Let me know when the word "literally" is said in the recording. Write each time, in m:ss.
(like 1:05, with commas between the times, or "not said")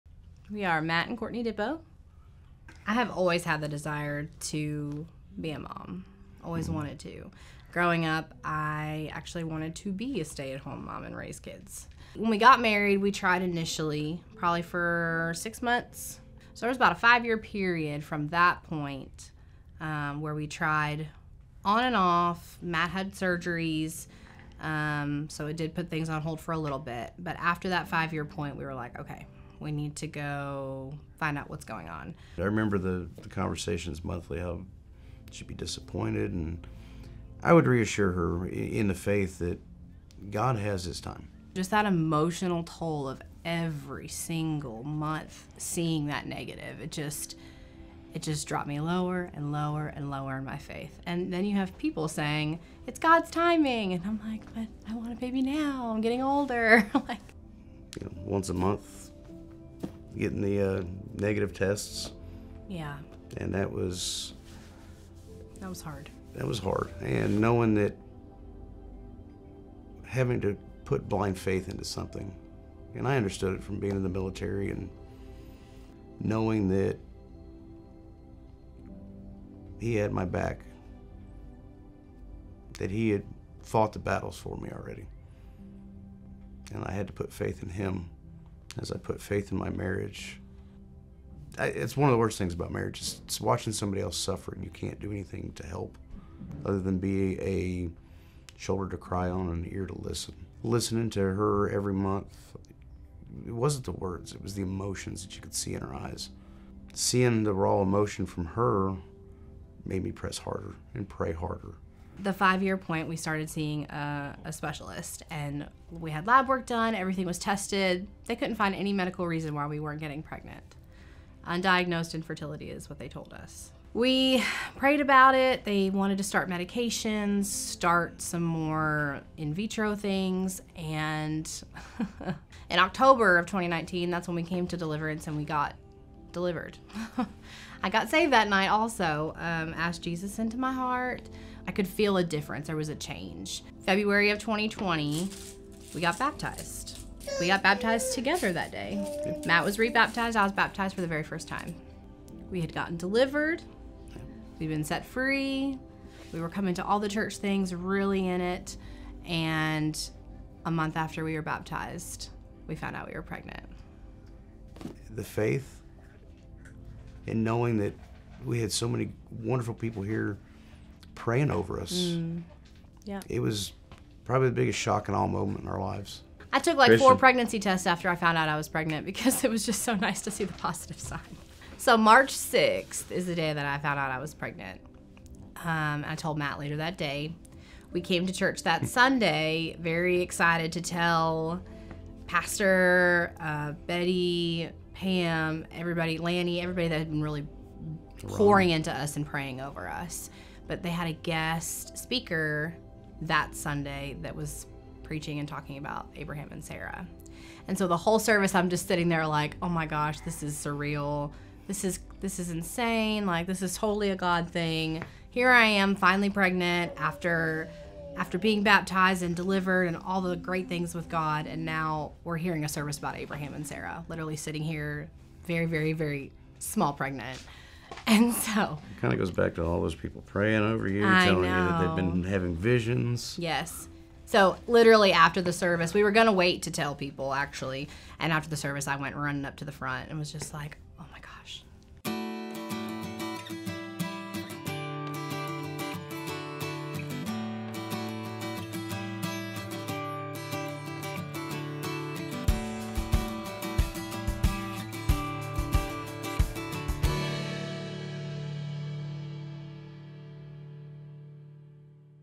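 3:44, 3:54.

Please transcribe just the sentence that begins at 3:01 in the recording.
So March 6th is the day that I found out I was pregnant.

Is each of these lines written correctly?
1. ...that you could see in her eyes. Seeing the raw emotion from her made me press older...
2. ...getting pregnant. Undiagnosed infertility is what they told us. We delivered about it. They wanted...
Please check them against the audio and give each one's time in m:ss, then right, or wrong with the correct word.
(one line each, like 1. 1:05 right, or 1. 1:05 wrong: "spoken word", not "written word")
1. 1:45 wrong: "harder", not "older"
2. 1:59 wrong: "prayed", not "delivered".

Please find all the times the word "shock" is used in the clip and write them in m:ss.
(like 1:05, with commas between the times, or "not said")
2:54.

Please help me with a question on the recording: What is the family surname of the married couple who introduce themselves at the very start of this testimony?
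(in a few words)
Dippo.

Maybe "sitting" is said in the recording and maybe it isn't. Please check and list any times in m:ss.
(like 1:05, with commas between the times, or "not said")
3:28, 3:44.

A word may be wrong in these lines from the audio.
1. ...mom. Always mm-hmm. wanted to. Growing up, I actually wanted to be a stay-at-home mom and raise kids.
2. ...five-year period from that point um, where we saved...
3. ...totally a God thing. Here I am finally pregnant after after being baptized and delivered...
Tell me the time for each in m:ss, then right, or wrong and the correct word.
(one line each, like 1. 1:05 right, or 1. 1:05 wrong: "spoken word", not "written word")
1. 0:05 right
2. 0:16 wrong: "tried", not "saved"
3. 3:33 right.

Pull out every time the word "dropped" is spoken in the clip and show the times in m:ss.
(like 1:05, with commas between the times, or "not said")
0:48.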